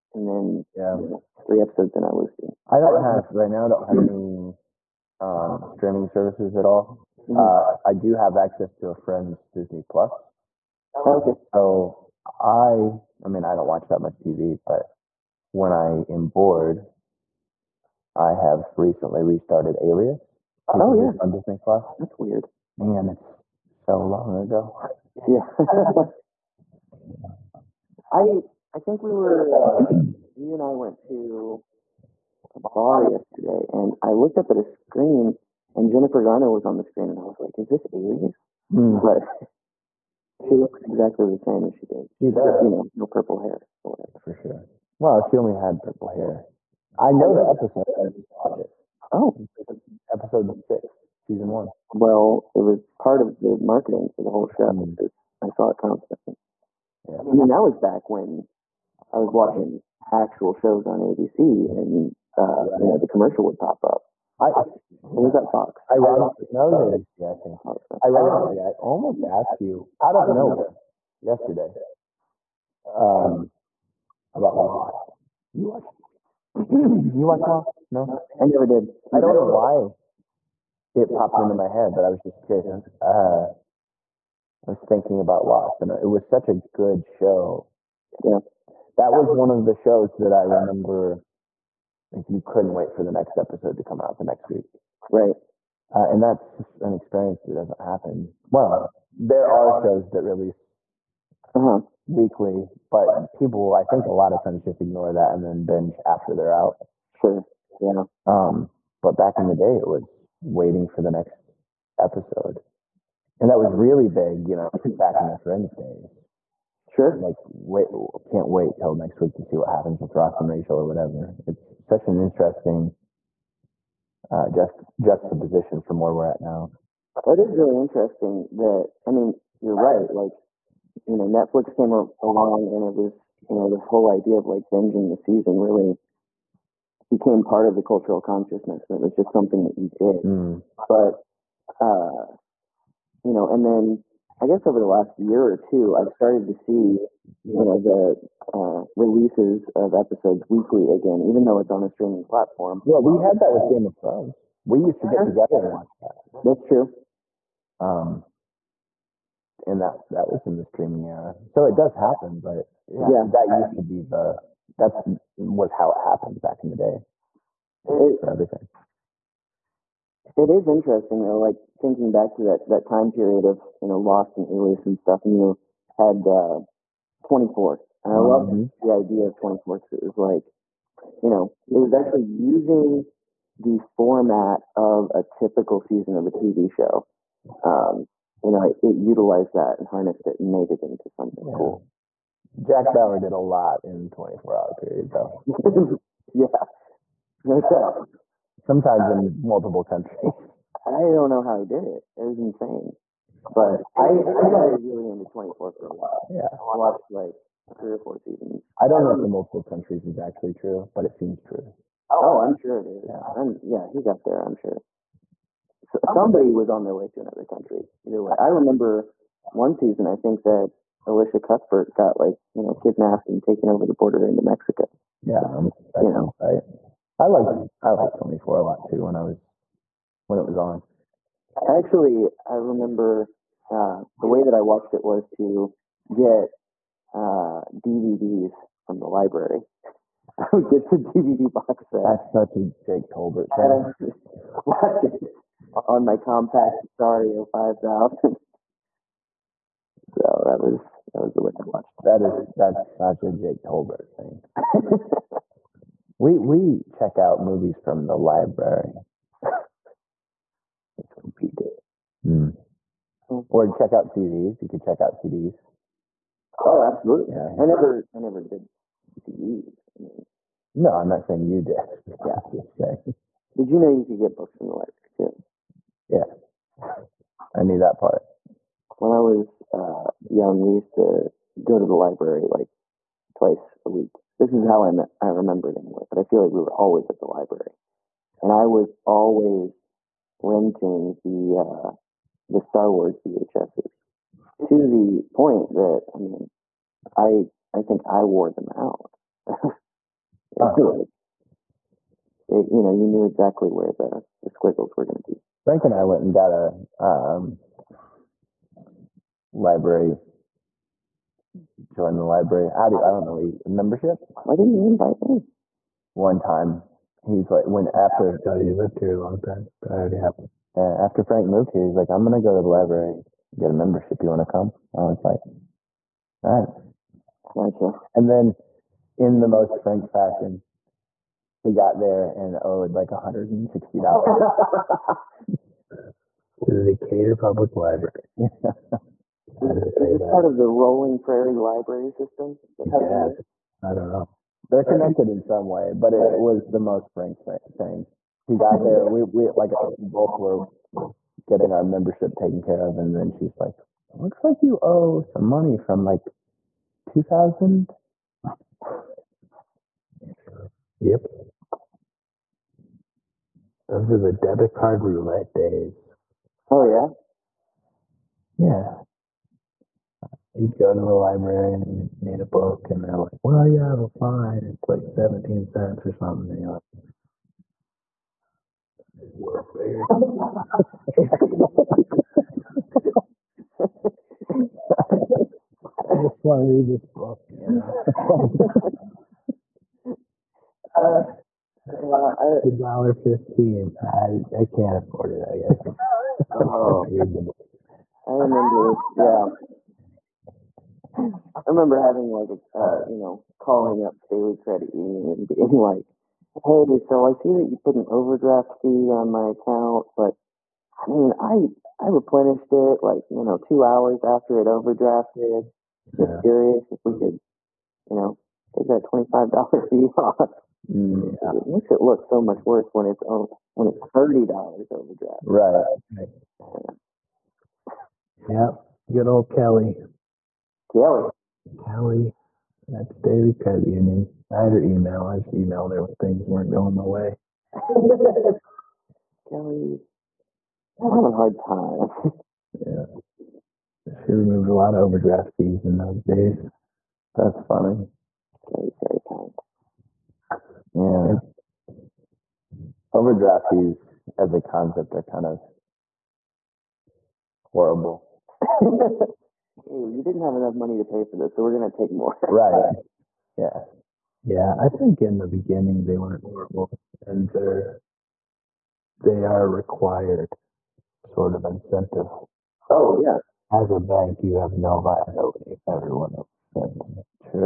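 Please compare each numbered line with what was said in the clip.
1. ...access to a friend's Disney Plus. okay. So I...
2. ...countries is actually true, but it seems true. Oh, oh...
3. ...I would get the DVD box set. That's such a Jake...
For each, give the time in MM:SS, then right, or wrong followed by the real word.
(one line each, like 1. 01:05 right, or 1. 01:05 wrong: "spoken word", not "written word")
1. 00:08 right
2. 03:29 right
3. 04:00 right.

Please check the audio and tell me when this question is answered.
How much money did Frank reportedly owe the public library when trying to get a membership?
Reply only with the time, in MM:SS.
05:33.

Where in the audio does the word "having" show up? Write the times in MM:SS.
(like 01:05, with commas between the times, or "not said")
06:42, 07:21.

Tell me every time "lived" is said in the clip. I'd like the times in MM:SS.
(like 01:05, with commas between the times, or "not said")
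05:18.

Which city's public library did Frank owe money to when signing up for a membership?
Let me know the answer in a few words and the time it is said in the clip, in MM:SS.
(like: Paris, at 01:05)
Decatur, at 05:36.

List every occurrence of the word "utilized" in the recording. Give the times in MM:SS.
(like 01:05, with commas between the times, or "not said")
03:08.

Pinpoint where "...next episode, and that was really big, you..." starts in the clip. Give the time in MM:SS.
01:51.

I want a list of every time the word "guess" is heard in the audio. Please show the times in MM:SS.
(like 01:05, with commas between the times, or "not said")
02:24, 06:35.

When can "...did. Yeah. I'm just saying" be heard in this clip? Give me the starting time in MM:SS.
04:31.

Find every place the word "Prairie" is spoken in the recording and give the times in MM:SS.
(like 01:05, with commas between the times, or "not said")
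05:41.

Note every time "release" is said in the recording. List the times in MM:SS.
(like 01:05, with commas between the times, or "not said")
01:40, 02:28.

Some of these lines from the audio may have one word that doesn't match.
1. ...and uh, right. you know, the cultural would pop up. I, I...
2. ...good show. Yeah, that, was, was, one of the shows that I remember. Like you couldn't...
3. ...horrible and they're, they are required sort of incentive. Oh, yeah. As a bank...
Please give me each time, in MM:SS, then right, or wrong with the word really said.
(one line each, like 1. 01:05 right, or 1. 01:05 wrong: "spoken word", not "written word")
1. 01:01 wrong: "commercial", not "cultural"
2. 01:26 right
3. 07:46 right.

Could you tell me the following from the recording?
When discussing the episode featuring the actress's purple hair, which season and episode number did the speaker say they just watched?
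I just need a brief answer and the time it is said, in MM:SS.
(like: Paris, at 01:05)
episode 6, season 1, at 00:50.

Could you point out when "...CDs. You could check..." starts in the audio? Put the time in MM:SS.
04:24.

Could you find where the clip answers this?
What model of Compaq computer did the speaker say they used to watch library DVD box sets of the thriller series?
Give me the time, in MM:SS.
04:06.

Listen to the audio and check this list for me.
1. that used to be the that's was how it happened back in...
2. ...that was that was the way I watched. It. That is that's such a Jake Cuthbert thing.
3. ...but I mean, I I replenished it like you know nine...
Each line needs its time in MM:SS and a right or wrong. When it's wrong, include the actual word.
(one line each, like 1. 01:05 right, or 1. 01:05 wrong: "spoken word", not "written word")
1. 02:43 right
2. 04:10 wrong: "Tolbert", not "Cuthbert"
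3. 06:50 wrong: "two", not "nine".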